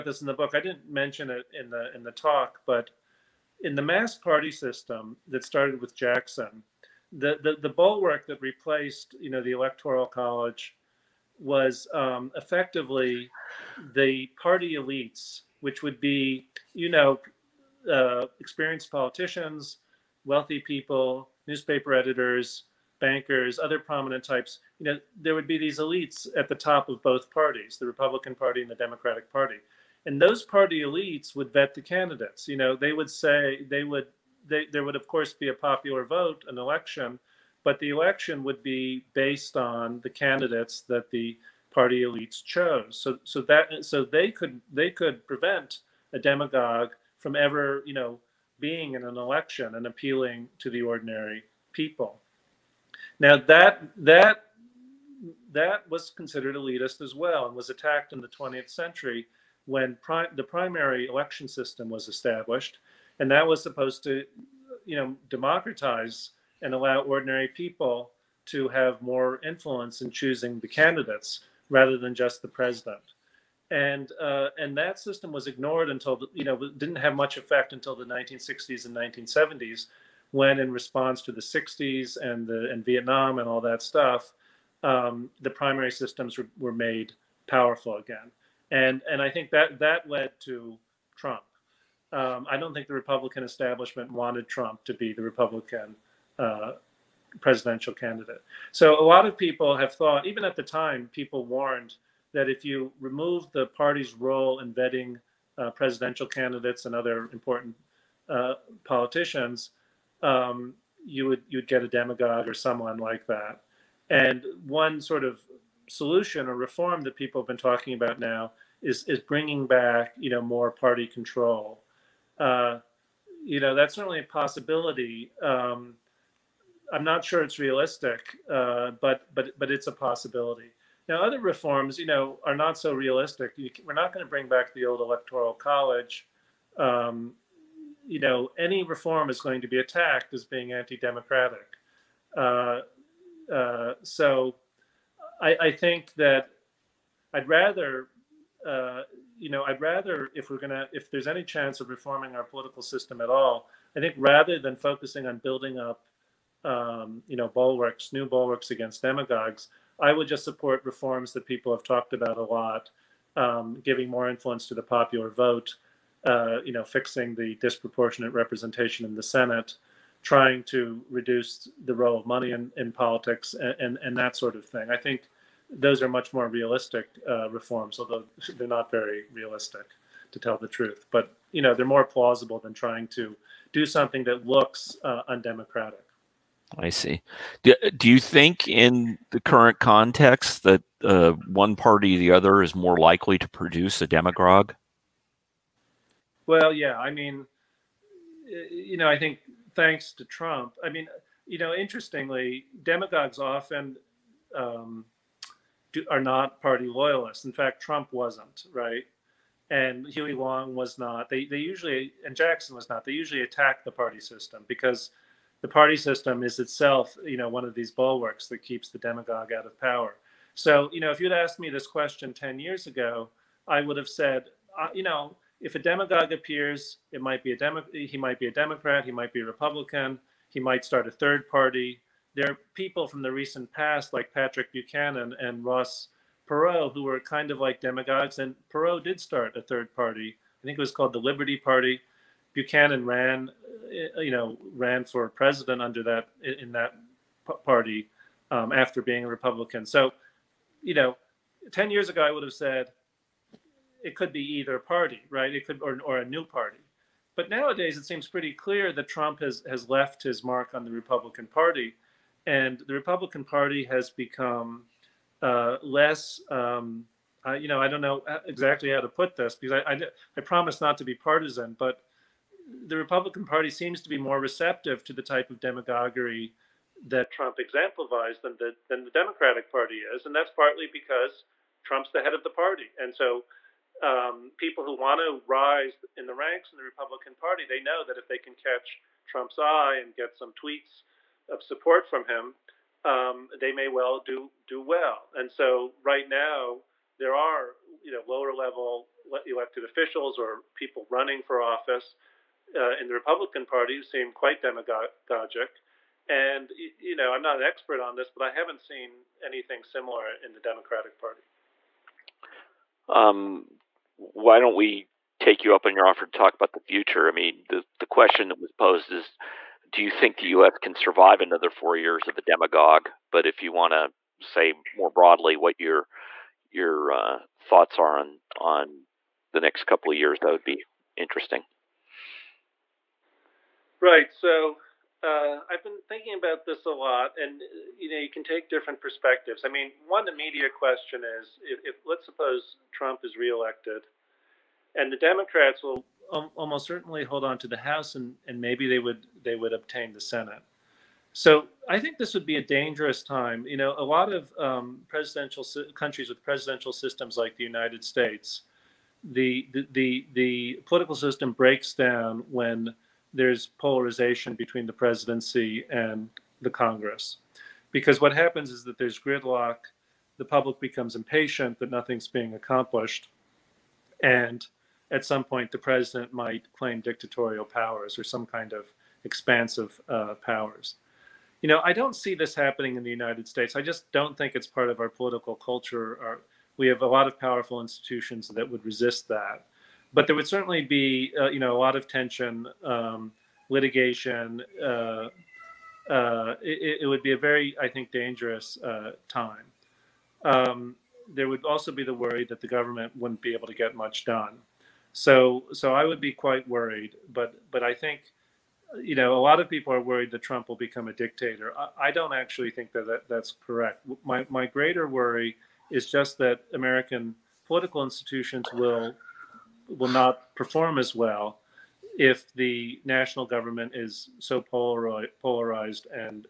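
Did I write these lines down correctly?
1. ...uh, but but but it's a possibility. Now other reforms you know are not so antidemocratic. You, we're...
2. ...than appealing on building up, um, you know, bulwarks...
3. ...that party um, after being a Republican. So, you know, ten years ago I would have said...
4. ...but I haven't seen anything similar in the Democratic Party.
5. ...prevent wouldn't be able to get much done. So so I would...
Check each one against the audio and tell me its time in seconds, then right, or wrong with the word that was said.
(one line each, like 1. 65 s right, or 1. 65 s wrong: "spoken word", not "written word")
1. 128 s wrong: "realistic", not "antidemocratic"
2. 154 s wrong: "focusing", not "appealing"
3. 246 s right
4. 308 s right
5. 402 s wrong: "government", not "prevent".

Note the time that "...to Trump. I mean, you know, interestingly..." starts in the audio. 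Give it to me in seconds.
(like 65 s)
200 s.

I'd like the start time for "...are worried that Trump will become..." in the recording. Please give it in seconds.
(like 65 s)
409 s.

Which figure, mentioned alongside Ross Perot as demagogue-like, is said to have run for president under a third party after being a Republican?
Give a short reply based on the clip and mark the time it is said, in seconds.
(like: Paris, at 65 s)
Patrick Buchanan, at 234 s.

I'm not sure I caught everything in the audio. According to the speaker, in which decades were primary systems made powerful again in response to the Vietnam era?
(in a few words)
1960s and 1970s.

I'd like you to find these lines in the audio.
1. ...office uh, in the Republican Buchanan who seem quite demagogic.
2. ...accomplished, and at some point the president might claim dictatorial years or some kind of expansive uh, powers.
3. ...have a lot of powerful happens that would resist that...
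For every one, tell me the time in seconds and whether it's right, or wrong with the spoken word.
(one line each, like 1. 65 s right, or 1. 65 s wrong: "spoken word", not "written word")
1. 301 s wrong: "Party", not "Buchanan"
2. 372 s wrong: "powers", not "years"
3. 386 s wrong: "institutions", not "happens".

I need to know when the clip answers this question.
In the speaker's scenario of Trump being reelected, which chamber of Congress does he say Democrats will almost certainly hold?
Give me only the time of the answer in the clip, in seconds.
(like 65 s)
347 s.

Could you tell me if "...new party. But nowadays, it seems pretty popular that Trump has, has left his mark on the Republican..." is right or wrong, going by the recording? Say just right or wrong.
wrong.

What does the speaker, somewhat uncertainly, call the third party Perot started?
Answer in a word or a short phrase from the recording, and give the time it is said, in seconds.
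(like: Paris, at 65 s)
Liberty Party, at 241 s.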